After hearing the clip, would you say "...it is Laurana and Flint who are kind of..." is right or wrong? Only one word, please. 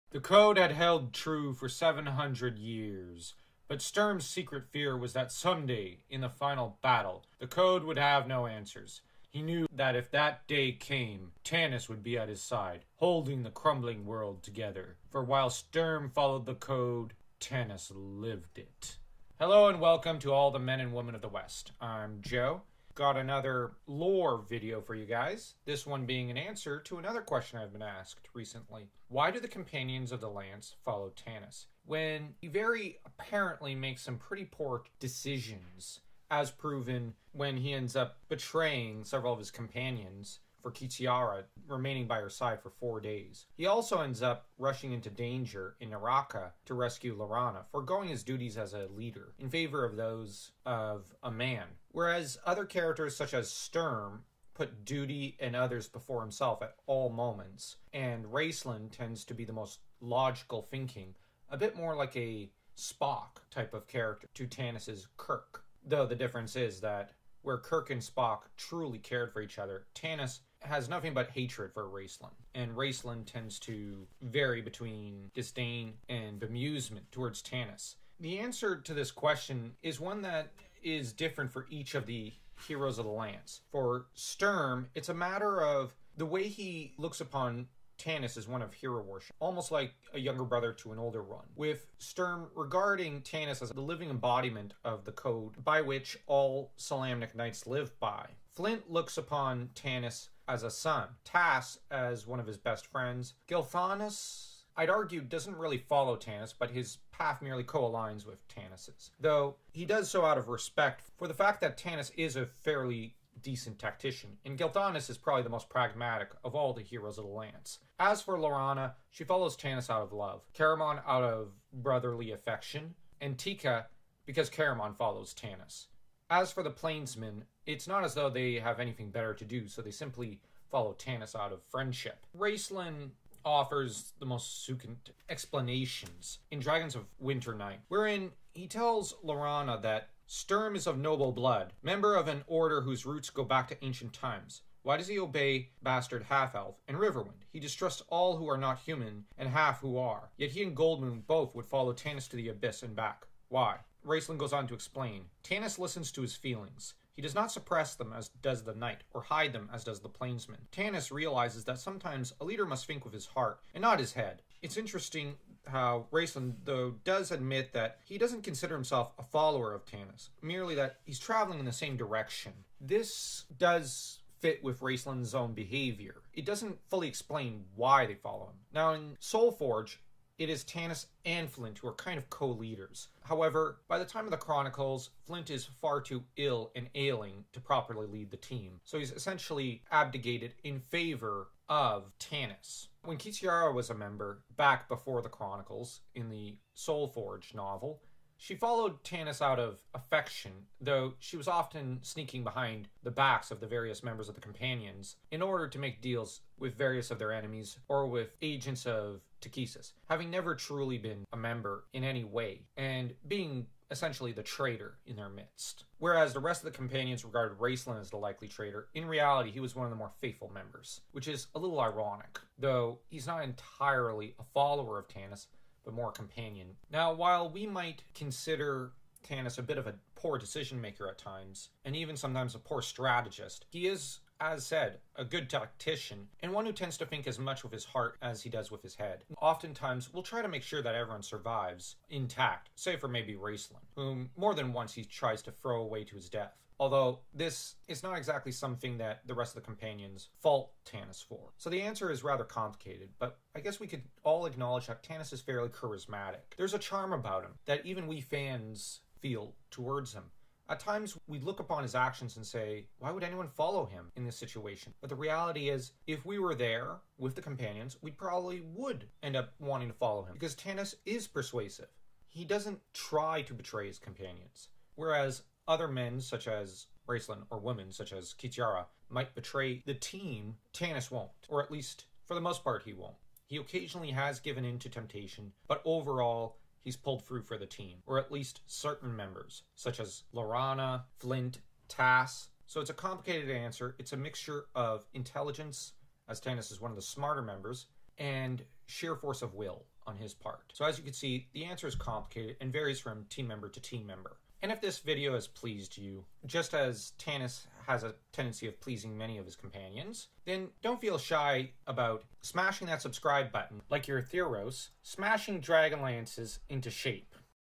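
wrong.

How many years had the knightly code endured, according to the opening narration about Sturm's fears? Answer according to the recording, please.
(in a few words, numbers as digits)
700.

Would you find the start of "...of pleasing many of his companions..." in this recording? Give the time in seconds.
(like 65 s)
308 s.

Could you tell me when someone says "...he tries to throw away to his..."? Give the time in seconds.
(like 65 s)
244 s.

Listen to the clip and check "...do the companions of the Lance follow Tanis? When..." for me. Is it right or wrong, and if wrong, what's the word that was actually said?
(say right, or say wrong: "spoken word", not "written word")
right.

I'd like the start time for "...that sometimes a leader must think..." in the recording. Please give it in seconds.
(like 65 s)
161 s.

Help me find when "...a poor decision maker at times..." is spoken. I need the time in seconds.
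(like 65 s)
229 s.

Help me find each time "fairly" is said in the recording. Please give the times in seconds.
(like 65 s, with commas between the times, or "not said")
112 s, 255 s.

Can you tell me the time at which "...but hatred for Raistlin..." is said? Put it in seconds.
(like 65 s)
71 s.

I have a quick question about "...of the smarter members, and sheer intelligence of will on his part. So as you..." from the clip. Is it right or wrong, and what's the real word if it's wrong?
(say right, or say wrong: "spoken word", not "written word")
wrong: "force", not "intelligence".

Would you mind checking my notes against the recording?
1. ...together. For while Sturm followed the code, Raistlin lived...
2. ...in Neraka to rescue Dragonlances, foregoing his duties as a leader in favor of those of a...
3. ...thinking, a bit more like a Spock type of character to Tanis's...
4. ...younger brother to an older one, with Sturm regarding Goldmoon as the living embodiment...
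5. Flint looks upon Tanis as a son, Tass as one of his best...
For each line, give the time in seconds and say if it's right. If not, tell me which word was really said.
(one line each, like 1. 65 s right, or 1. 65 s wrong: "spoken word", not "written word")
1. 14 s wrong: "Tanis", not "Raistlin"
2. 45 s wrong: "Laurana", not "Dragonlances"
3. 60 s right
4. 90 s wrong: "Tanis", not "Goldmoon"
5. 98 s right.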